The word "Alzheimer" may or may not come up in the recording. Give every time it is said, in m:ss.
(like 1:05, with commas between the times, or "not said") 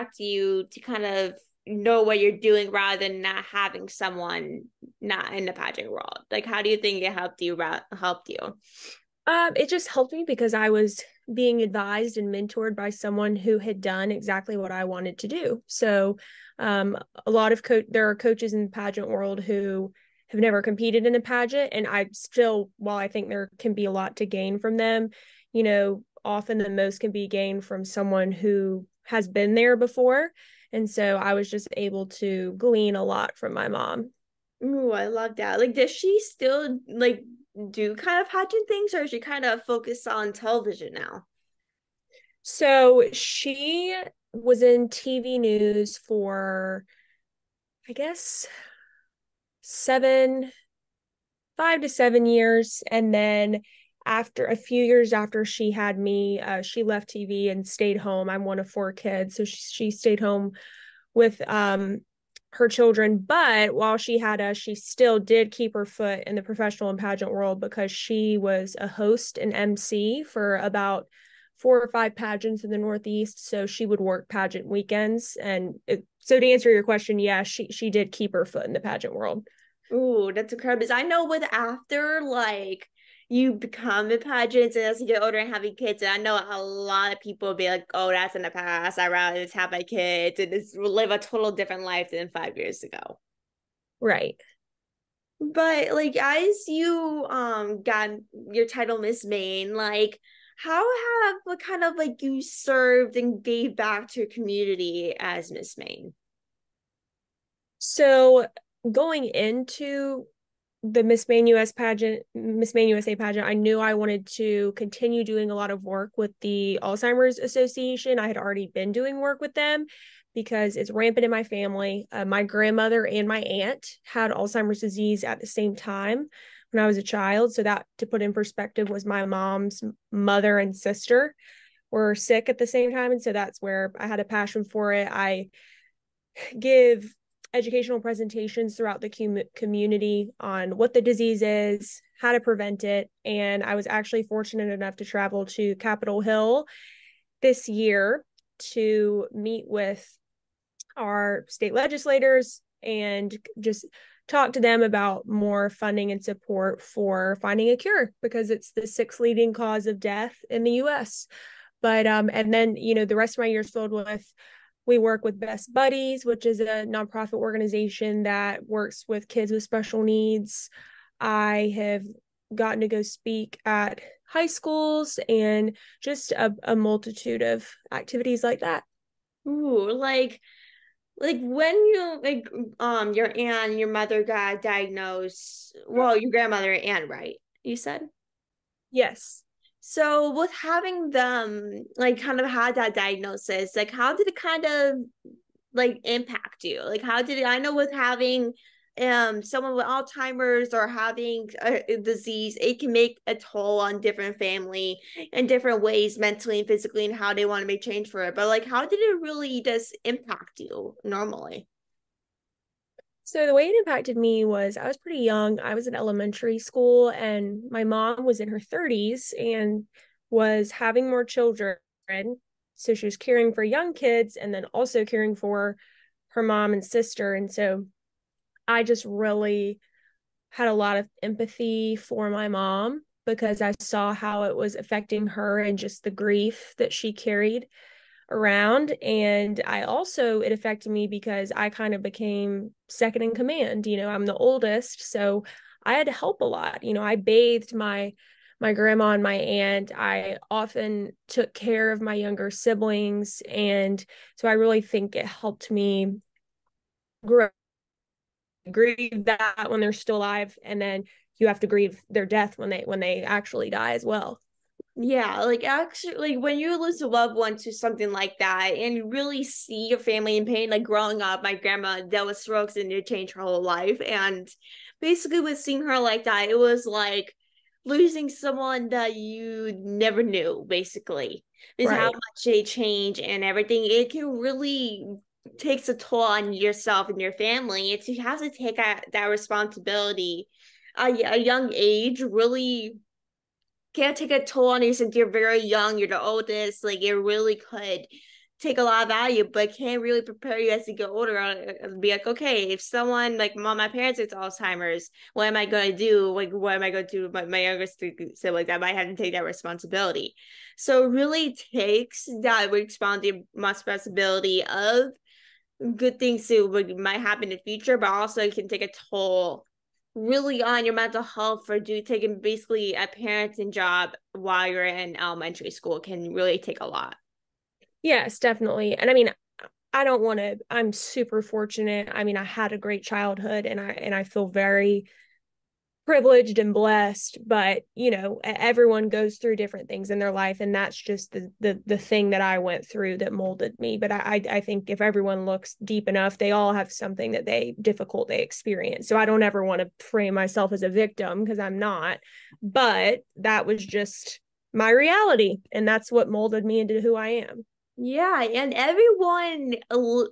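1:56, 2:04, 3:19, 5:04.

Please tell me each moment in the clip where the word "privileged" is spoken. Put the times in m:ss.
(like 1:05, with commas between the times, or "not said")
5:36.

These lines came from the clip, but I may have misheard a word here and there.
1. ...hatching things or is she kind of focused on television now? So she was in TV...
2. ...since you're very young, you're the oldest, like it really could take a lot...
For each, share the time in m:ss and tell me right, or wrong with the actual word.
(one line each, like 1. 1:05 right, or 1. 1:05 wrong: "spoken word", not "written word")
1. 0:38 right
2. 4:54 right.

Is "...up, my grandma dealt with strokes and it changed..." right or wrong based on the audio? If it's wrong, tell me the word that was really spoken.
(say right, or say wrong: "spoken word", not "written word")
right.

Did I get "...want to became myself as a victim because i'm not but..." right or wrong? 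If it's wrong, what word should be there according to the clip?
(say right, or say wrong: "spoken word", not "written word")
wrong: "frame", not "became".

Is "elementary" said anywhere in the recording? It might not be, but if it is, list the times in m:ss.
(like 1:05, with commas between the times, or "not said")
3:35, 5:25.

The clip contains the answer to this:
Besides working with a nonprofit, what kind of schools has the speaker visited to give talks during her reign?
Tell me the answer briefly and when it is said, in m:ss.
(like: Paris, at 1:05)
high schools, at 2:54.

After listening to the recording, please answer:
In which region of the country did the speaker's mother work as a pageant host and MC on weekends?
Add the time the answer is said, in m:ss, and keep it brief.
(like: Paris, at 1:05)
Northeast, at 1:12.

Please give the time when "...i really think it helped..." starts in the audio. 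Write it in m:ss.
4:14.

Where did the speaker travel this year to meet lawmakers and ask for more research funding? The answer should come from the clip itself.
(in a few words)
Capitol Hill.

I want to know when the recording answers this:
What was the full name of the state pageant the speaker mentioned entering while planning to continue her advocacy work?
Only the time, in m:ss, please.
1:52.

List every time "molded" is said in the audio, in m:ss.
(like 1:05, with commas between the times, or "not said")
5:43, 5:56.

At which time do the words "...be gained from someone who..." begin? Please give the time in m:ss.
0:27.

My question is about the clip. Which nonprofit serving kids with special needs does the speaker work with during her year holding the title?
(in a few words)
Best Buddies.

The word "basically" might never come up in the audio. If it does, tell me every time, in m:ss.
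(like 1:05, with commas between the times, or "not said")
4:35, 4:40, 5:22.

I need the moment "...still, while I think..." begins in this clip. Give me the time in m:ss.
0:22.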